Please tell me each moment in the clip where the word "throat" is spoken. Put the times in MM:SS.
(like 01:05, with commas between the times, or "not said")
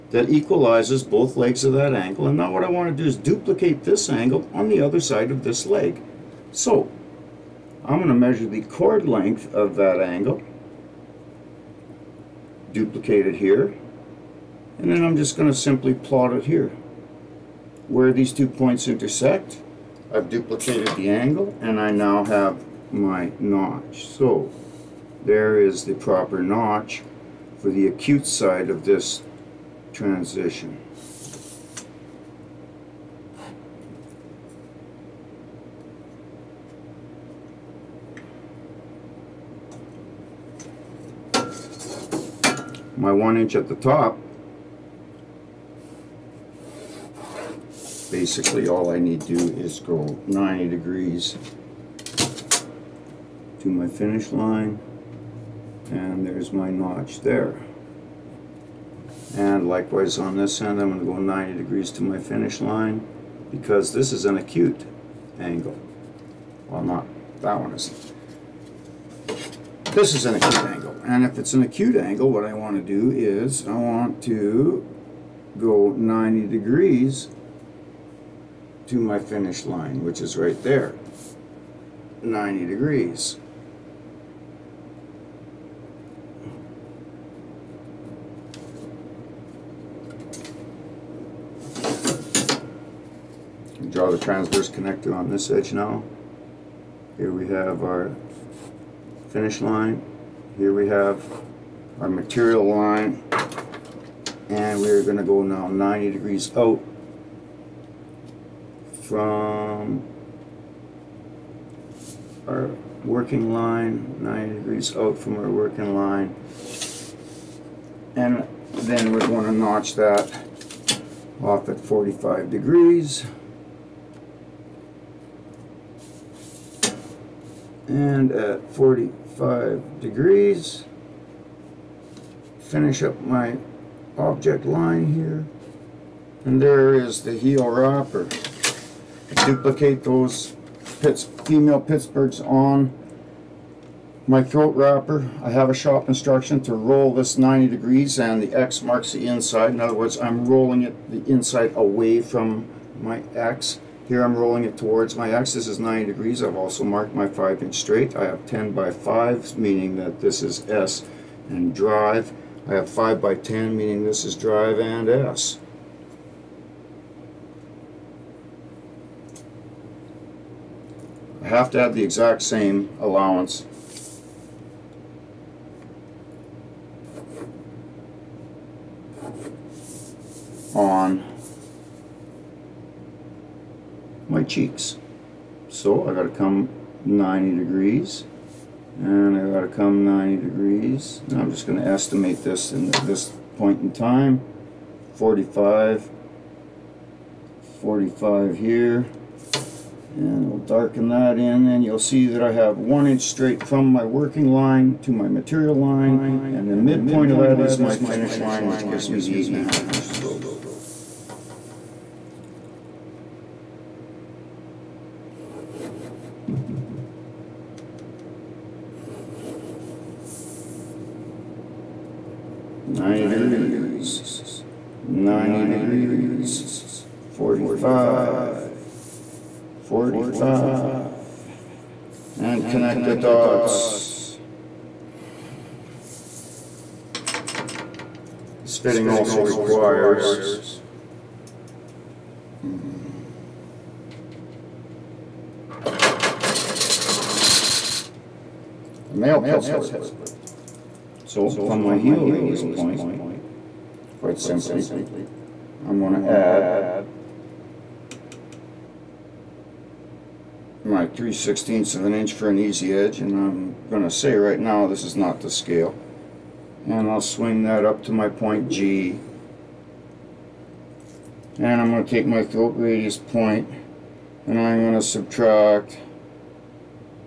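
02:24, 04:32.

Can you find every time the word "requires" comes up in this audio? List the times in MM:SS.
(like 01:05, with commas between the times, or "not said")
03:59.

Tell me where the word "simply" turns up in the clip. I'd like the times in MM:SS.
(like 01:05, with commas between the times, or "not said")
00:15, 04:14.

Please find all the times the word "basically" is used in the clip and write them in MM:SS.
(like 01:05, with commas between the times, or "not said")
00:48.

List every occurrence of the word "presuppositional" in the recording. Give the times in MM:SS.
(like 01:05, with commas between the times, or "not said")
not said.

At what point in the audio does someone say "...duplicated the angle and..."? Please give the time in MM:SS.
00:20.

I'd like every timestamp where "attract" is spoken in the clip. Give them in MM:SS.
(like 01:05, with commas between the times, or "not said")
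not said.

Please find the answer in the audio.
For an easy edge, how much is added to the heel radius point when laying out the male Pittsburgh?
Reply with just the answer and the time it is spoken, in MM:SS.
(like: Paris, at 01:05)
3/16 inch, at 04:21.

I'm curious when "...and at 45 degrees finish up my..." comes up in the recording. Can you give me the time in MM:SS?
02:07.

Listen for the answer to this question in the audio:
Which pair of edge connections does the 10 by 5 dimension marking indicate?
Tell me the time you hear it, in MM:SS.
02:40.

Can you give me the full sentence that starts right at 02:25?
I have a shop instruction to roll this 90 degrees and the X marks the inside.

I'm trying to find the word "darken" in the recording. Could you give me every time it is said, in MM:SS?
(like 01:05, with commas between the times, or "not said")
03:20.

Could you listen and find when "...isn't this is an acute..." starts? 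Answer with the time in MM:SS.
01:07.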